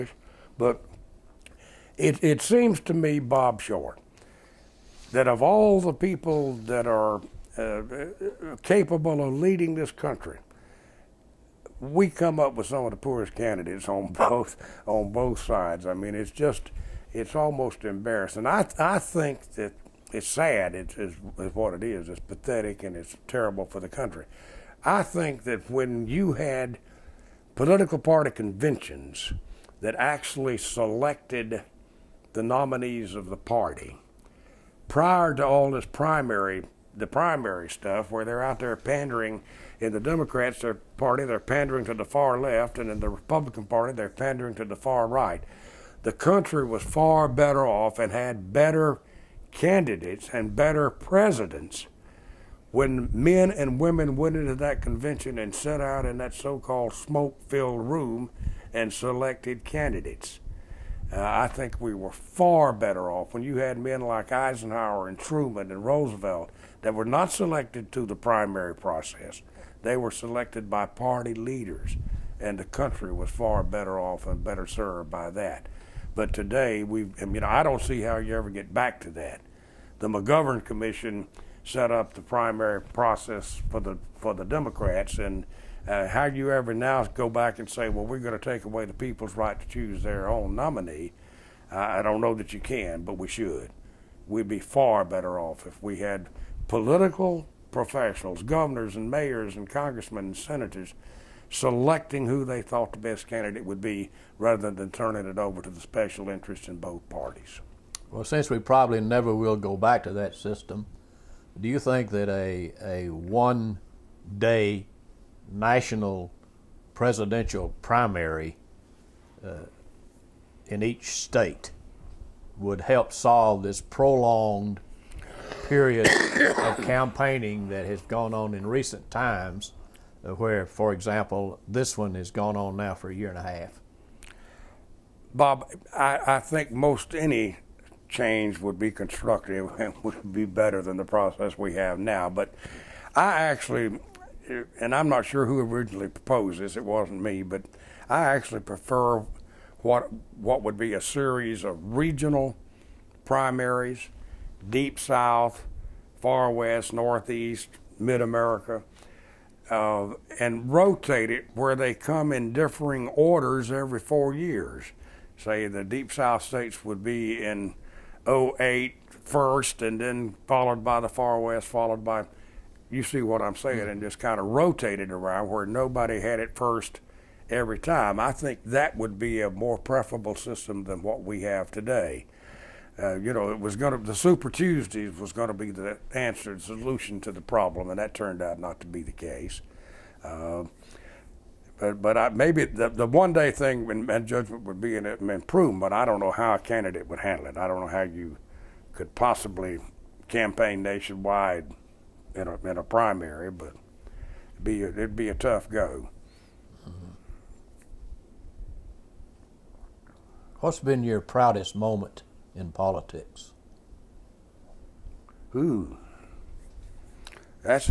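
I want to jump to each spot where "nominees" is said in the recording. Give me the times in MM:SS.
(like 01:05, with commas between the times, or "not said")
00:32, 01:30.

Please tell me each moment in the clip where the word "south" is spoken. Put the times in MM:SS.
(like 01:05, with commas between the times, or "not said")
02:34, 02:46.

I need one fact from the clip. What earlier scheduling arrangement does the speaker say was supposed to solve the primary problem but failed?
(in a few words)
Super Tuesdays.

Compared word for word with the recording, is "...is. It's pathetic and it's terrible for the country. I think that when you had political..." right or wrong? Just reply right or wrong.
right.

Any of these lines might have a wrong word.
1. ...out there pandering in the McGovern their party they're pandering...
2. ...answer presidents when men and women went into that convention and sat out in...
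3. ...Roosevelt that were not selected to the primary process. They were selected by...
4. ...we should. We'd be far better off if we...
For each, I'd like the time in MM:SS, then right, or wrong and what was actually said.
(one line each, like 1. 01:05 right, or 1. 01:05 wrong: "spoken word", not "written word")
1. 00:38 wrong: "Democrats", not "McGovern"
2. 00:50 wrong: "better", not "answer"
3. 01:05 right
4. 01:33 right.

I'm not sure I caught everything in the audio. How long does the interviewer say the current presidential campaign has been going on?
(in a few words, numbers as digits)
a year and a half.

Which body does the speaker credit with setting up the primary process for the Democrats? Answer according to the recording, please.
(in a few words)
McGovern Commission.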